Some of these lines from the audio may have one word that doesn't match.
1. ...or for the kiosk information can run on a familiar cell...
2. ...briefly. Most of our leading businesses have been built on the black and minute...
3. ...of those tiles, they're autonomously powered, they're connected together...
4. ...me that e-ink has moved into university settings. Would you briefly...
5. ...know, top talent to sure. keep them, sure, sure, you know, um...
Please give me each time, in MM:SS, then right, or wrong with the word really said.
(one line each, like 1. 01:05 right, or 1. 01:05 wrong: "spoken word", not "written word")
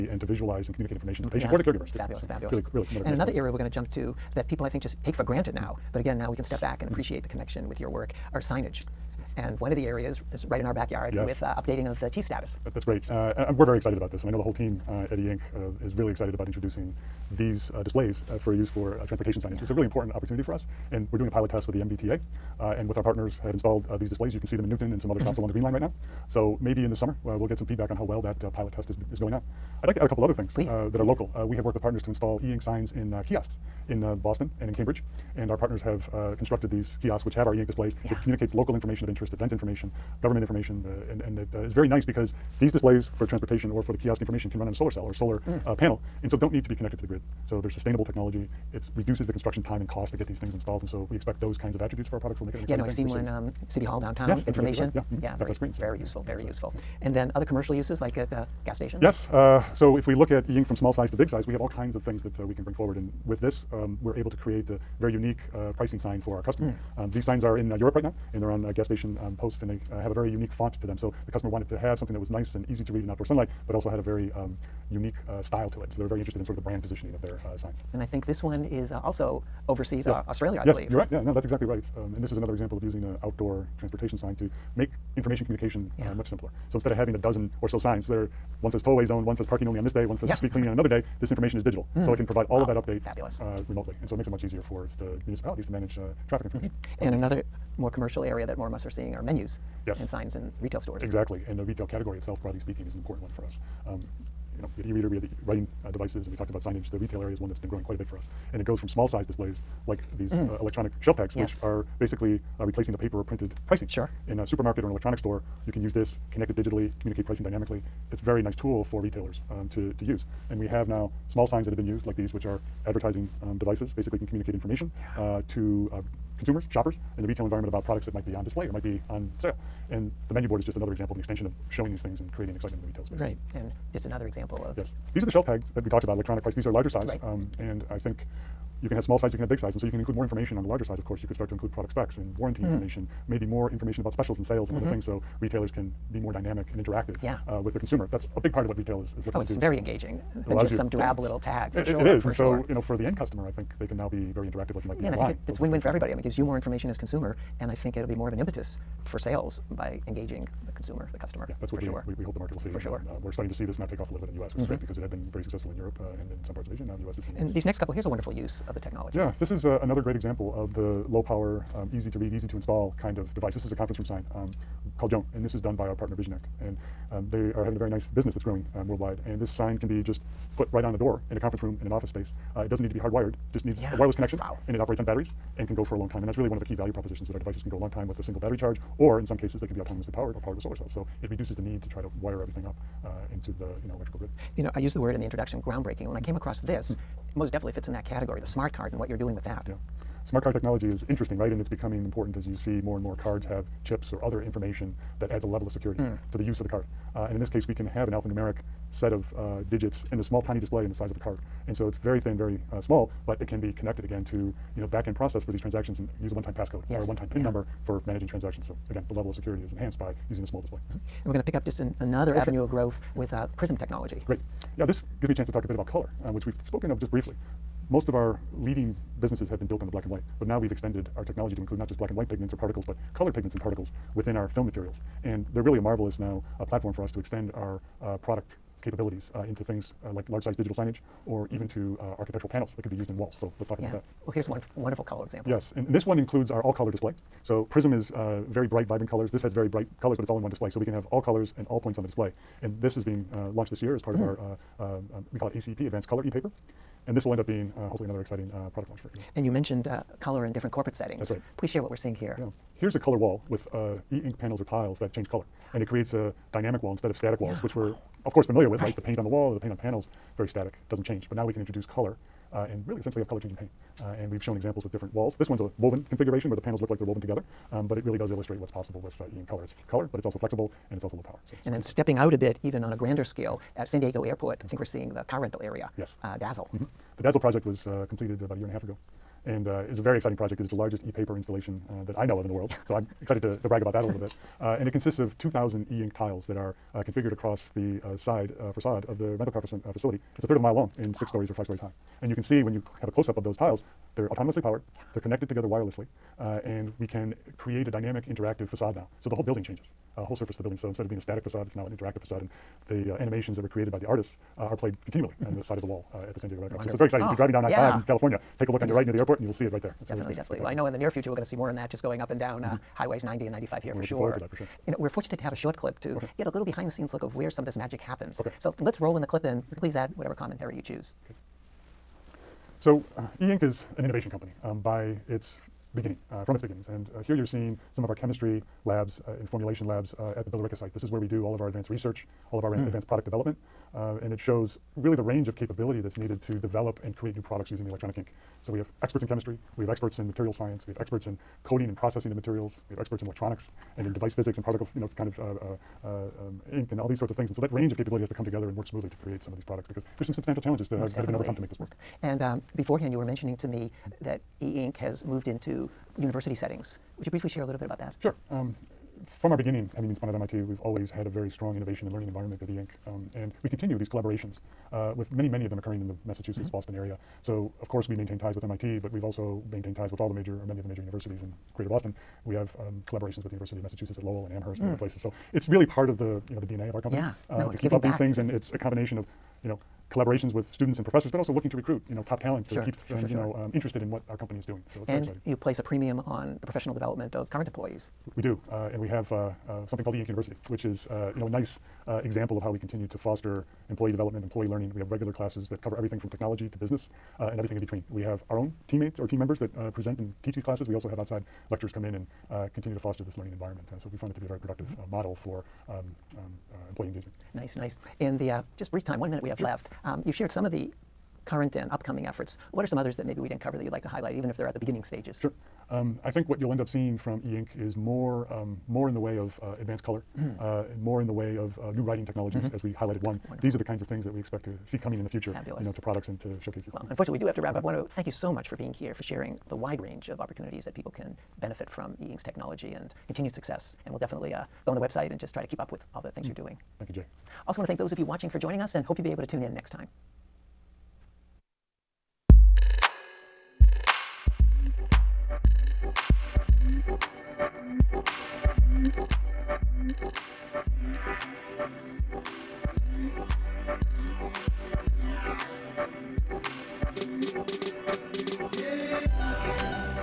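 1. 00:43 wrong: "solar", not "familiar"
2. 03:47 wrong: "white", not "minute"
3. 05:03 right
4. 06:03 right
5. 06:32 right.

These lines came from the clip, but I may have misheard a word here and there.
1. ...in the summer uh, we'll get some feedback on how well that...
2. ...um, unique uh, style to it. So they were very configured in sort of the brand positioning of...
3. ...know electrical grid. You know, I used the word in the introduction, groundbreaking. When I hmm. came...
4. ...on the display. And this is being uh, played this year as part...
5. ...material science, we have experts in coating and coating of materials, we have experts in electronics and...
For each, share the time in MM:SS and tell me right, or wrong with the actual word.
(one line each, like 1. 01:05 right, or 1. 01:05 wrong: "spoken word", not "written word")
1. 00:26 right
2. 01:14 wrong: "interested", not "configured"
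3. 03:13 right
4. 04:11 wrong: "launched", not "played"
5. 05:50 wrong: "processing", not "coating".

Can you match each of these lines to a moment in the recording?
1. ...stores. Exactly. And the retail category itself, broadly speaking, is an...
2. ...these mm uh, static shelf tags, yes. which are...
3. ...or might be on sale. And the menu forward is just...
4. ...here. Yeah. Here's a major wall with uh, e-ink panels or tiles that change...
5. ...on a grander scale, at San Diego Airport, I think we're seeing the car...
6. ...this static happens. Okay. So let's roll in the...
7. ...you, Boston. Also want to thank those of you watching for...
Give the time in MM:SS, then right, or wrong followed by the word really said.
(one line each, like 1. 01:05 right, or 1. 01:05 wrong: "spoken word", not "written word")
1. 01:40 right
2. 01:50 wrong: "electronic", not "static"
3. 02:08 wrong: "board", not "forward"
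4. 04:22 wrong: "color", not "major"
5. 04:42 right
6. 05:27 wrong: "magic", not "static"
7. 07:27 wrong: "Jay", not "Boston".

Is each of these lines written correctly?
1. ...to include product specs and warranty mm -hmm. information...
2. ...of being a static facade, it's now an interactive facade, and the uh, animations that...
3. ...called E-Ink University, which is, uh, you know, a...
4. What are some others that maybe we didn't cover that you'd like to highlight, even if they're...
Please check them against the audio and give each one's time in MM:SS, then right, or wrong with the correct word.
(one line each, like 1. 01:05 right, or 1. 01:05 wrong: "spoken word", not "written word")
1. 02:21 right
2. 05:11 right
3. 06:40 right
4. 07:02 right.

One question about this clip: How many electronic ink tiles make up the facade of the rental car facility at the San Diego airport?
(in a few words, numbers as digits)
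2,000.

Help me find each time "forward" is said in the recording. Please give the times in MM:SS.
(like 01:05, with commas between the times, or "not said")
01:02, 05:24.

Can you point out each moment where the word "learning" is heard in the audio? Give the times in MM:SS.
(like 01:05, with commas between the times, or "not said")
06:12, 06:44, 06:53.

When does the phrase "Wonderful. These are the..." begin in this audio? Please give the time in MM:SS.
07:13.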